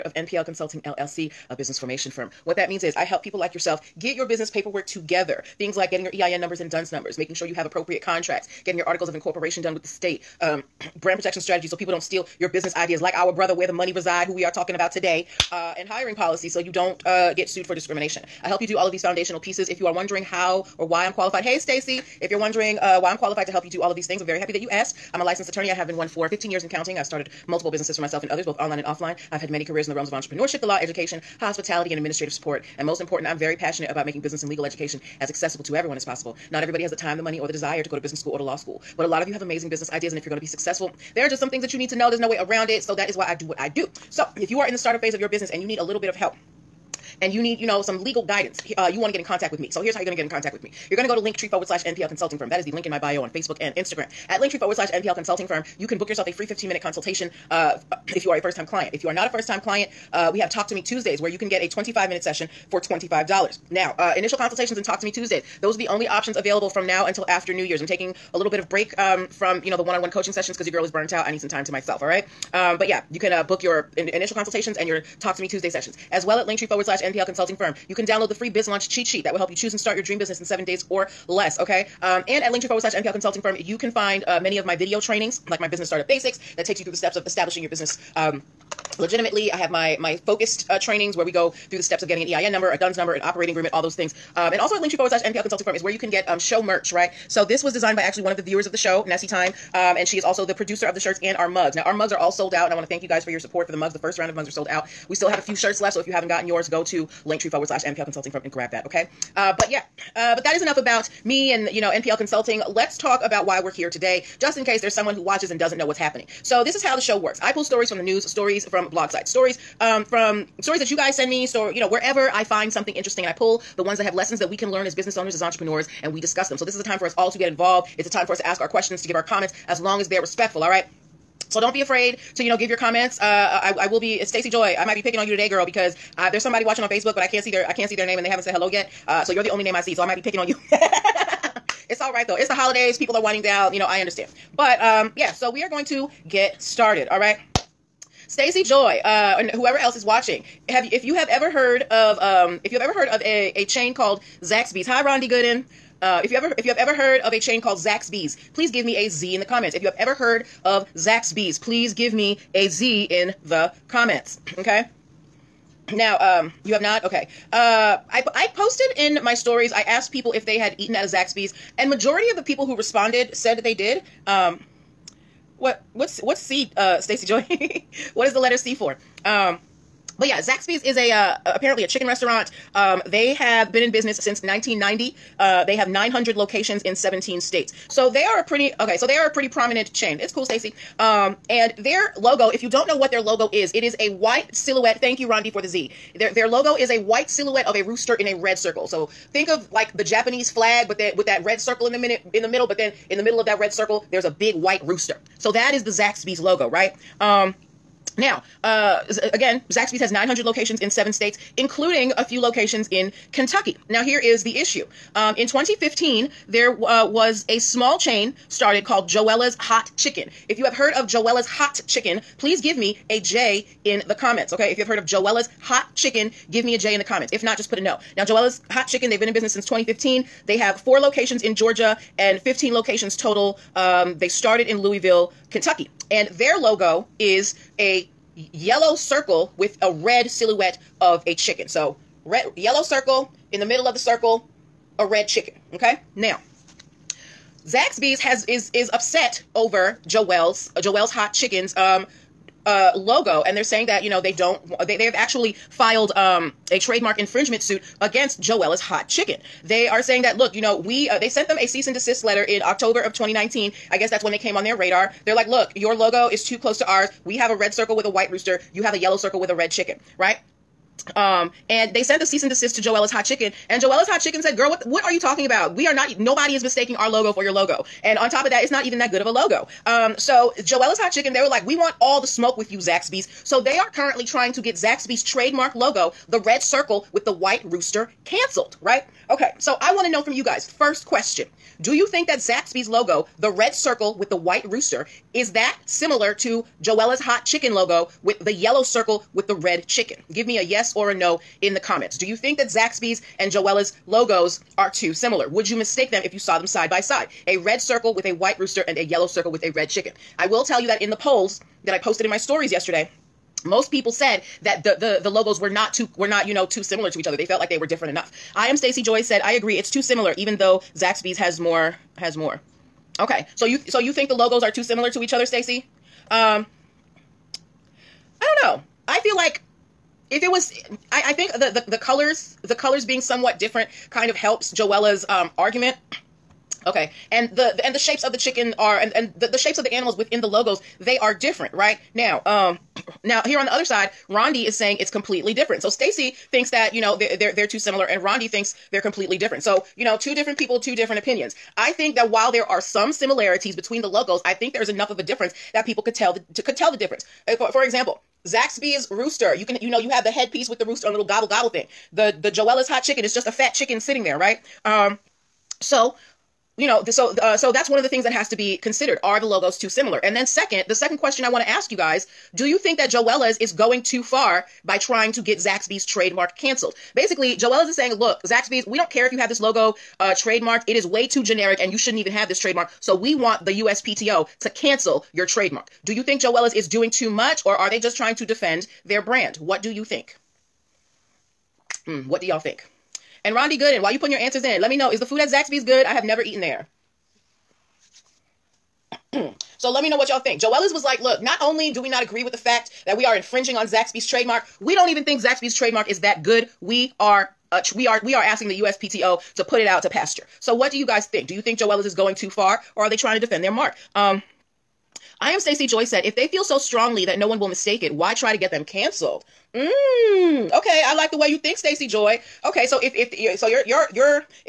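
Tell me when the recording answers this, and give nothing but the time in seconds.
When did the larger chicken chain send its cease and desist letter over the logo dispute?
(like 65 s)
262 s.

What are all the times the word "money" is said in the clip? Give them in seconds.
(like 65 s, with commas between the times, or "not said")
13 s, 37 s.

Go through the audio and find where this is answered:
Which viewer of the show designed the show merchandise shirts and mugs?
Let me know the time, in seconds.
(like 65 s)
99 s.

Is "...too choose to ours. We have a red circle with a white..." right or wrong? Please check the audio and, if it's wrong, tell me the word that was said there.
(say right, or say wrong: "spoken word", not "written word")
wrong: "close", not "choose".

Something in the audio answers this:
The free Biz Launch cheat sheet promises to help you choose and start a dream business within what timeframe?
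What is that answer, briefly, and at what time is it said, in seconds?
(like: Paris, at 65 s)
7 days or less, at 80 s.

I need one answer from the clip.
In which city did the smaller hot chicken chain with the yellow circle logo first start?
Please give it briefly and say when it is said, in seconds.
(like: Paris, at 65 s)
Louisville, at 234 s.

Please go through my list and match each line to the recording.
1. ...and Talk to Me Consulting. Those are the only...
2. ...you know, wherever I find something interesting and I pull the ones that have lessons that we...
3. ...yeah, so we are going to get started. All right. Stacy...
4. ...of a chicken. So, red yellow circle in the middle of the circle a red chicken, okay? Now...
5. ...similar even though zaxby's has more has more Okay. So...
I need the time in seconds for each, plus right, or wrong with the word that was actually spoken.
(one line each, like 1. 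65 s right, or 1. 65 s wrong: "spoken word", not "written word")
1. 64 s wrong: "Tuesdays", not "Consulting"
2. 121 s right
3. 145 s right
4. 241 s right
5. 320 s right.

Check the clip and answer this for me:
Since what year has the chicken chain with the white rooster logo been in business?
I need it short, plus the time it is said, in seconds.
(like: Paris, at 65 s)
1990, at 184 s.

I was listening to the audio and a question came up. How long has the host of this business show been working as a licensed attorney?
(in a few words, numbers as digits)
15 years.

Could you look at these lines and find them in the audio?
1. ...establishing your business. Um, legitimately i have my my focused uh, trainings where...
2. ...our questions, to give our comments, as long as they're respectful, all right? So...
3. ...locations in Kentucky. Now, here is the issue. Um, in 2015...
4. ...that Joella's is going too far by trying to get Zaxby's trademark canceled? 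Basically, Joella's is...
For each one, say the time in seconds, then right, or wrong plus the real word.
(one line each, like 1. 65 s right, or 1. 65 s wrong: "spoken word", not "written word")
1. 87 s right
2. 128 s right
3. 212 s right
4. 372 s right.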